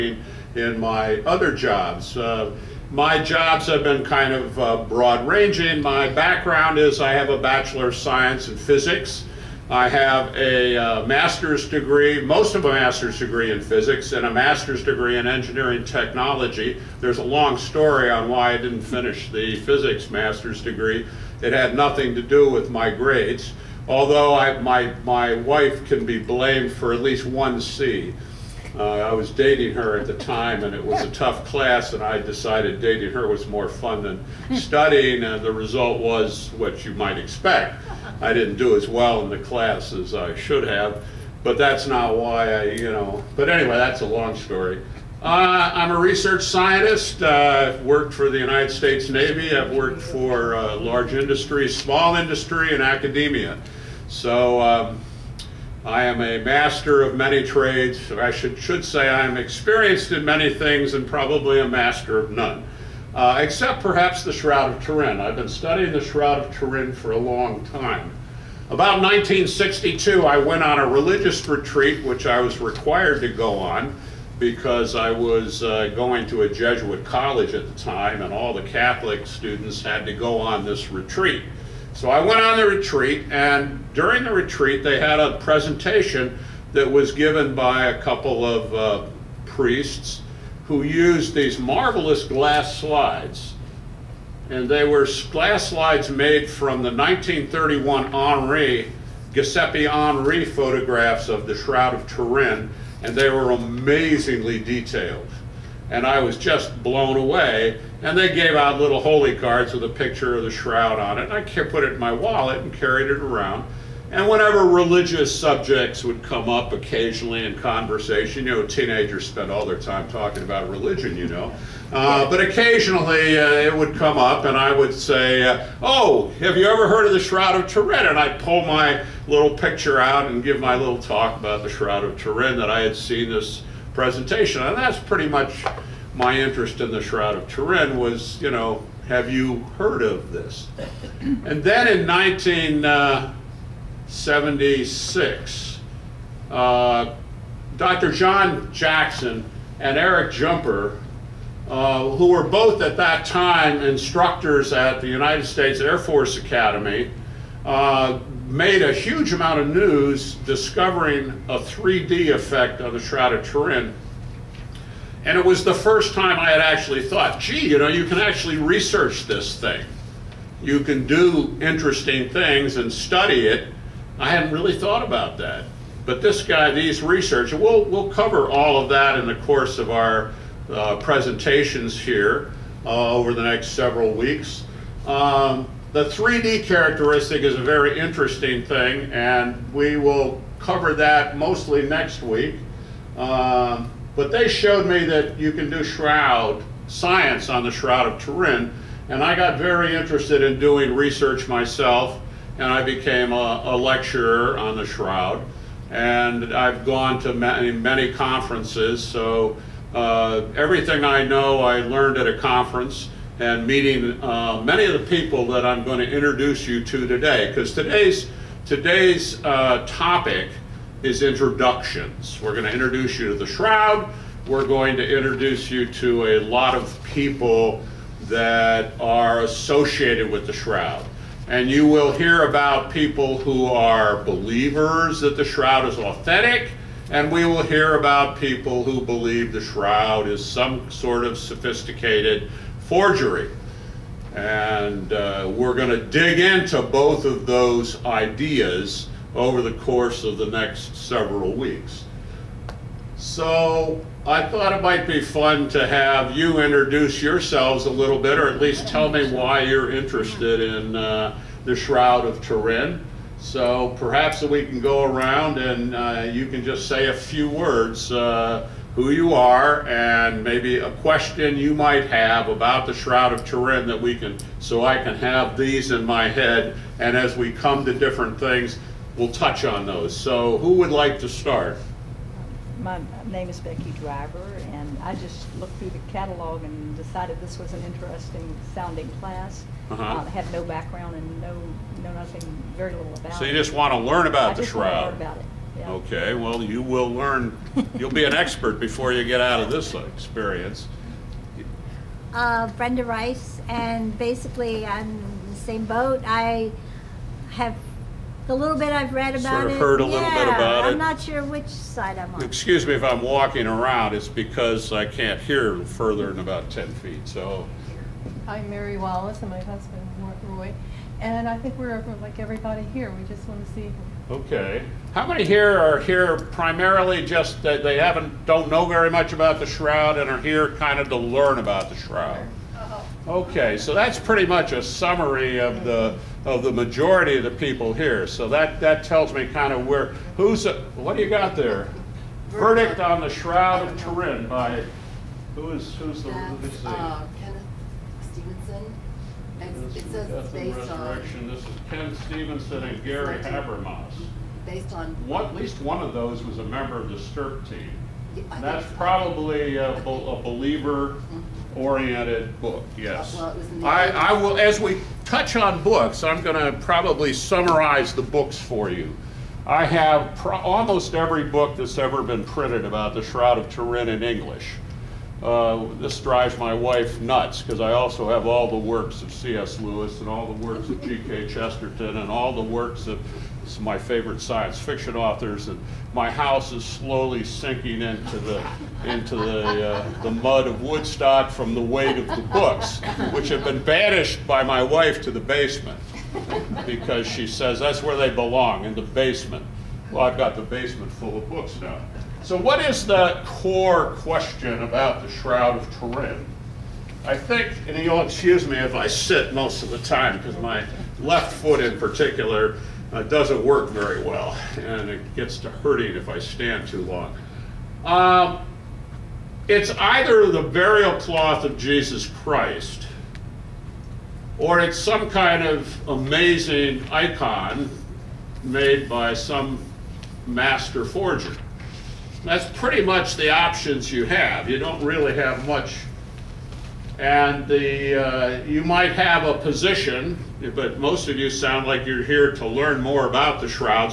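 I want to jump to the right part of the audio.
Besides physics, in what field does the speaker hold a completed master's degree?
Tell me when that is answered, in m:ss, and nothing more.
0:15.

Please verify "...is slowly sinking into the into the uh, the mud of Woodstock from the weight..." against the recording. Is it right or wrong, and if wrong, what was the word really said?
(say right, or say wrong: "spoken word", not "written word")
right.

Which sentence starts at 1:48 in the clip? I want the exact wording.
And they gave out little holy cards with a picture of the shroud on it.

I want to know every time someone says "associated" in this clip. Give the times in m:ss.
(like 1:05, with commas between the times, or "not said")
3:49.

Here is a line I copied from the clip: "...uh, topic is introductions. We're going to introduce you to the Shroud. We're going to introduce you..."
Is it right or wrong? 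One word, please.
right.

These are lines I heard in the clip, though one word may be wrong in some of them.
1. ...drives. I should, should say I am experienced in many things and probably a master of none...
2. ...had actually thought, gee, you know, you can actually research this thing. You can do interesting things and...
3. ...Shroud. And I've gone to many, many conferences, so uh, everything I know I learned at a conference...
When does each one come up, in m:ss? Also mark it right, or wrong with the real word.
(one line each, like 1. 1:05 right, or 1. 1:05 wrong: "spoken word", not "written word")
1. 0:57 wrong: "trades", not "drives"
2. 2:46 right
3. 3:24 right.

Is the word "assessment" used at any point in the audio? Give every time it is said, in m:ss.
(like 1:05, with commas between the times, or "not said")
not said.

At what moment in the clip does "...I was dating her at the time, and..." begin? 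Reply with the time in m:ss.
0:28.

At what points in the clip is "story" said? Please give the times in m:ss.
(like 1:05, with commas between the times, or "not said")
0:17, 0:44.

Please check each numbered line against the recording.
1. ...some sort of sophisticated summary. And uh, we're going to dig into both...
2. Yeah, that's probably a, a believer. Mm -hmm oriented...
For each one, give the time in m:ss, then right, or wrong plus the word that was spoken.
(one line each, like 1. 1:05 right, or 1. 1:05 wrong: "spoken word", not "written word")
1. 4:00 wrong: "forgery", not "summary"
2. 5:58 right.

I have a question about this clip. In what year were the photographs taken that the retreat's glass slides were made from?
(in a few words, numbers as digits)
1931.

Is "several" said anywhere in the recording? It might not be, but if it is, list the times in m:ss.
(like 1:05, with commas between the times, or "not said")
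3:03, 4:10.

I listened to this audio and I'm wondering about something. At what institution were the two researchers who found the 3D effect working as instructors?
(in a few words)
United States Air Force Academy.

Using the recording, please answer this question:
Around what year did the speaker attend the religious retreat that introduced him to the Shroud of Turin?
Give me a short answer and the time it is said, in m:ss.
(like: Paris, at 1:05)
1962, at 1:09.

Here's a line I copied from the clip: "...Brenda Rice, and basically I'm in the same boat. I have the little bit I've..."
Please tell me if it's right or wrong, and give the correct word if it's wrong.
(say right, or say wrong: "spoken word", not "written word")
right.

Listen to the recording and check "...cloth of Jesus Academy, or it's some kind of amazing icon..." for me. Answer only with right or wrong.
wrong.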